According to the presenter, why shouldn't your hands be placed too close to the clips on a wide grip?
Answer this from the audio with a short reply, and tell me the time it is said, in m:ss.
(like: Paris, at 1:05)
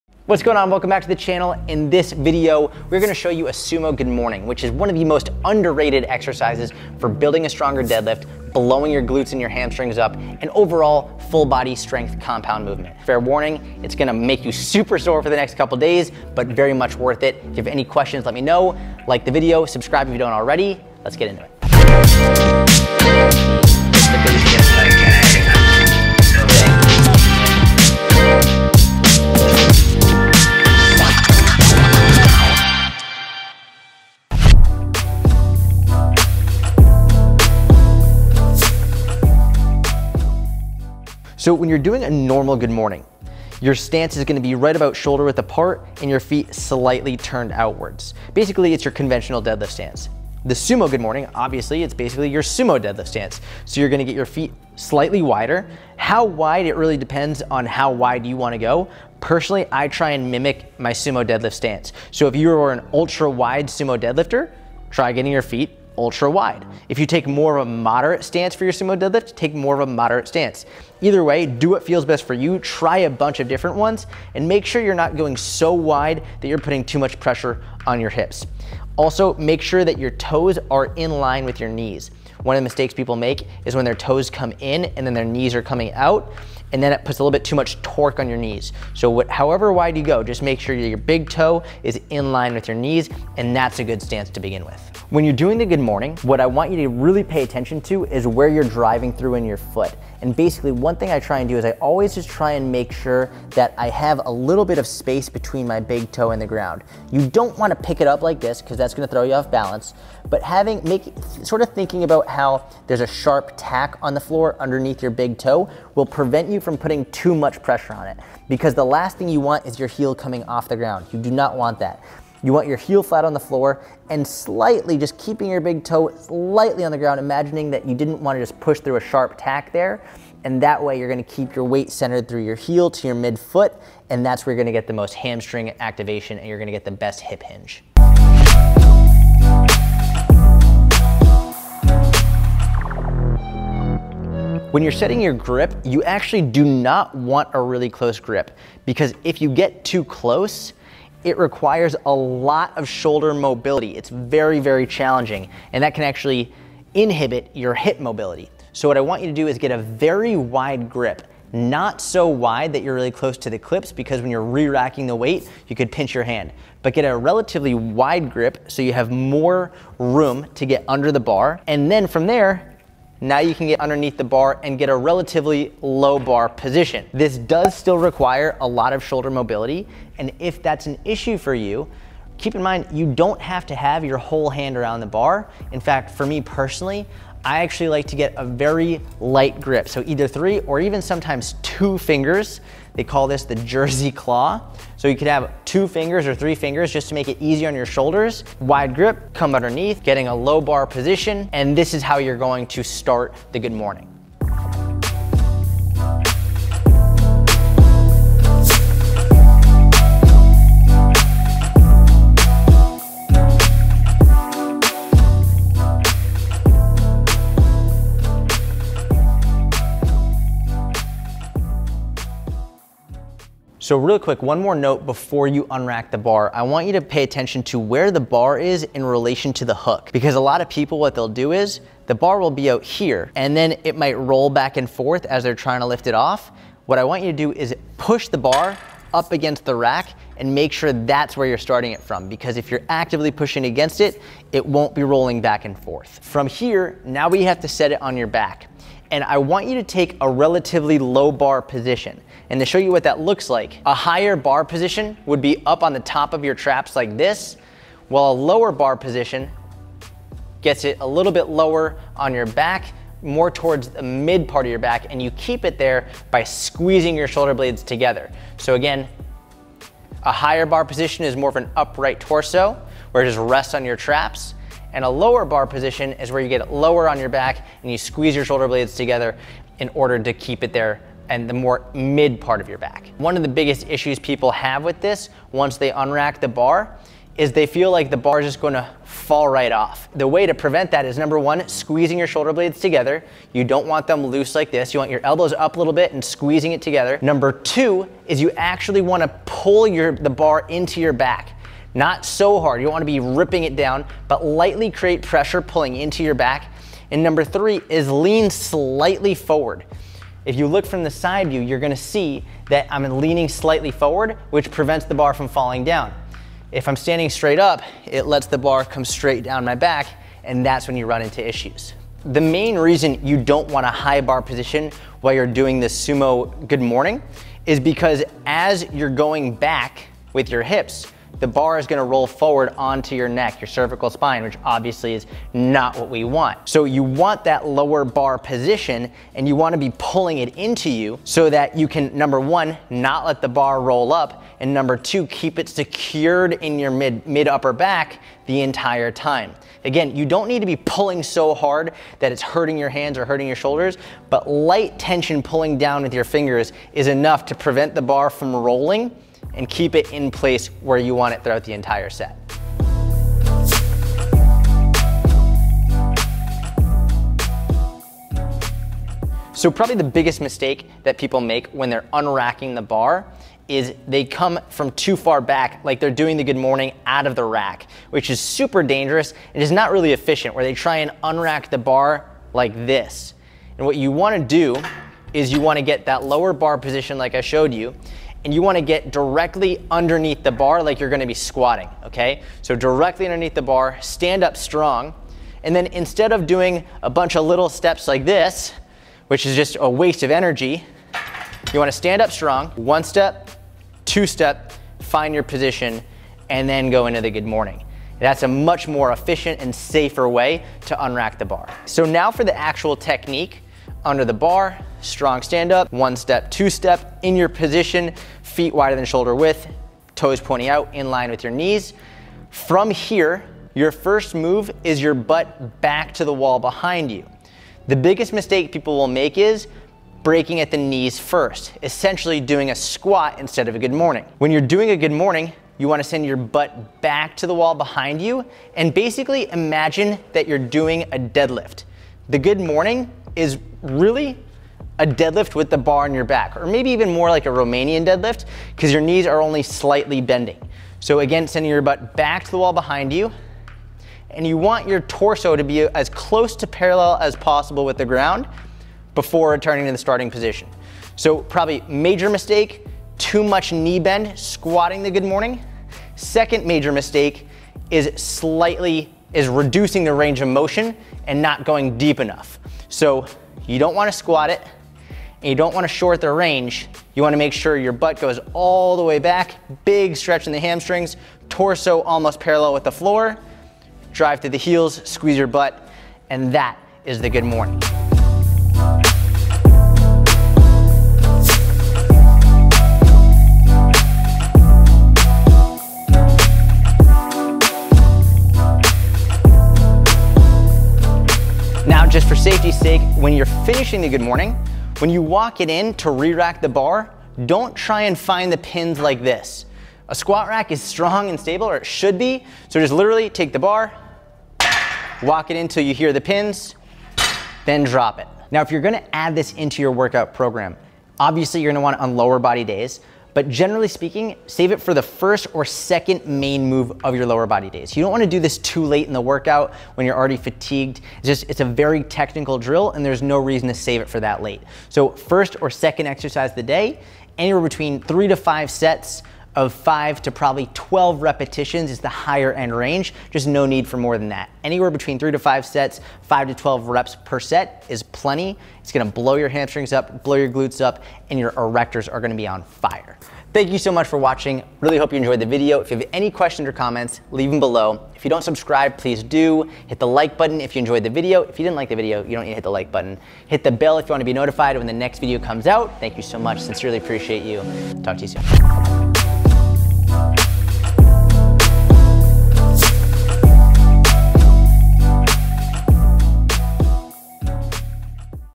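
You could pinch your hand, at 2:45.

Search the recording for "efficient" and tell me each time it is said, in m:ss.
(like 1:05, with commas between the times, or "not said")
6:20, 6:49.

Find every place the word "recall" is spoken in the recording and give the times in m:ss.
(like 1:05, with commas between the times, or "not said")
not said.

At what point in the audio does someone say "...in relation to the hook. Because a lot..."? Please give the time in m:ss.
3:48.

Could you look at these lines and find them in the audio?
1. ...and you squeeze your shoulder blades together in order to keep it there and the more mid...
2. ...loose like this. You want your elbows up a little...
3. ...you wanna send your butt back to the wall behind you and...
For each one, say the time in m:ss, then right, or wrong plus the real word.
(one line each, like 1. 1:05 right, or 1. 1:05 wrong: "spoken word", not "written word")
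1. 4:37 right
2. 4:54 right
3. 7:15 right.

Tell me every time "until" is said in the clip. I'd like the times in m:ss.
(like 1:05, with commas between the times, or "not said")
8:35.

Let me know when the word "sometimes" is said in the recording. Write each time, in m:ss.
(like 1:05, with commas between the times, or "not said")
3:11.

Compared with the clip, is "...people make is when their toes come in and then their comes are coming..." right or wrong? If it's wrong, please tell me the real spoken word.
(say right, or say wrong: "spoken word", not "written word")
wrong: "knees", not "comes".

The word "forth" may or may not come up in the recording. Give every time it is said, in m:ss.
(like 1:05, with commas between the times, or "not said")
3:54, 4:05.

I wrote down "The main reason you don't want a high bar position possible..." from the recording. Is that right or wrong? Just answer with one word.
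wrong.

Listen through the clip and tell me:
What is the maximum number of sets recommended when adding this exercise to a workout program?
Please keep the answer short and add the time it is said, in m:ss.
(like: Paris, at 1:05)
5, at 8:58.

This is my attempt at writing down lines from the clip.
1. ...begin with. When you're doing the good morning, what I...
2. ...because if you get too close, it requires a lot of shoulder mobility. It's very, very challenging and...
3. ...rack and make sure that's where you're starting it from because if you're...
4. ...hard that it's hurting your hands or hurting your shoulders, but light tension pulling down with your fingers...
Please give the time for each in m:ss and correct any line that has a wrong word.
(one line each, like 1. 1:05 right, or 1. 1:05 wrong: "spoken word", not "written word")
1. 1:34 right
2. 2:28 right
3. 3:59 right
4. 5:51 right.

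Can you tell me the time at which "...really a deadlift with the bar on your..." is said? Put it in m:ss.
7:23.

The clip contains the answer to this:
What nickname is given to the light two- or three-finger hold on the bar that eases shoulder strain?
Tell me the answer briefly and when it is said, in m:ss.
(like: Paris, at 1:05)
Jersey claw, at 3:13.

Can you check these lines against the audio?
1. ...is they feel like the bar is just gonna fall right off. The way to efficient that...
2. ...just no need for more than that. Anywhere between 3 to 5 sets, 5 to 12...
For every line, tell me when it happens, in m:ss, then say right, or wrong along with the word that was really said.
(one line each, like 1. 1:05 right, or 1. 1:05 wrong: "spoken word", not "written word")
1. 4:47 wrong: "prevent", not "efficient"
2. 9:03 right.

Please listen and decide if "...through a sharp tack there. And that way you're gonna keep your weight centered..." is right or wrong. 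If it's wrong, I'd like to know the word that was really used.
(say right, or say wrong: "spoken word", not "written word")
right.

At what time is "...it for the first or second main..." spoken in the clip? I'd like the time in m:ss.
8:44.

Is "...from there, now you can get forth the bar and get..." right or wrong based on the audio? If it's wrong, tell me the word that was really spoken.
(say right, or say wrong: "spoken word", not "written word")
wrong: "underneath", not "forth".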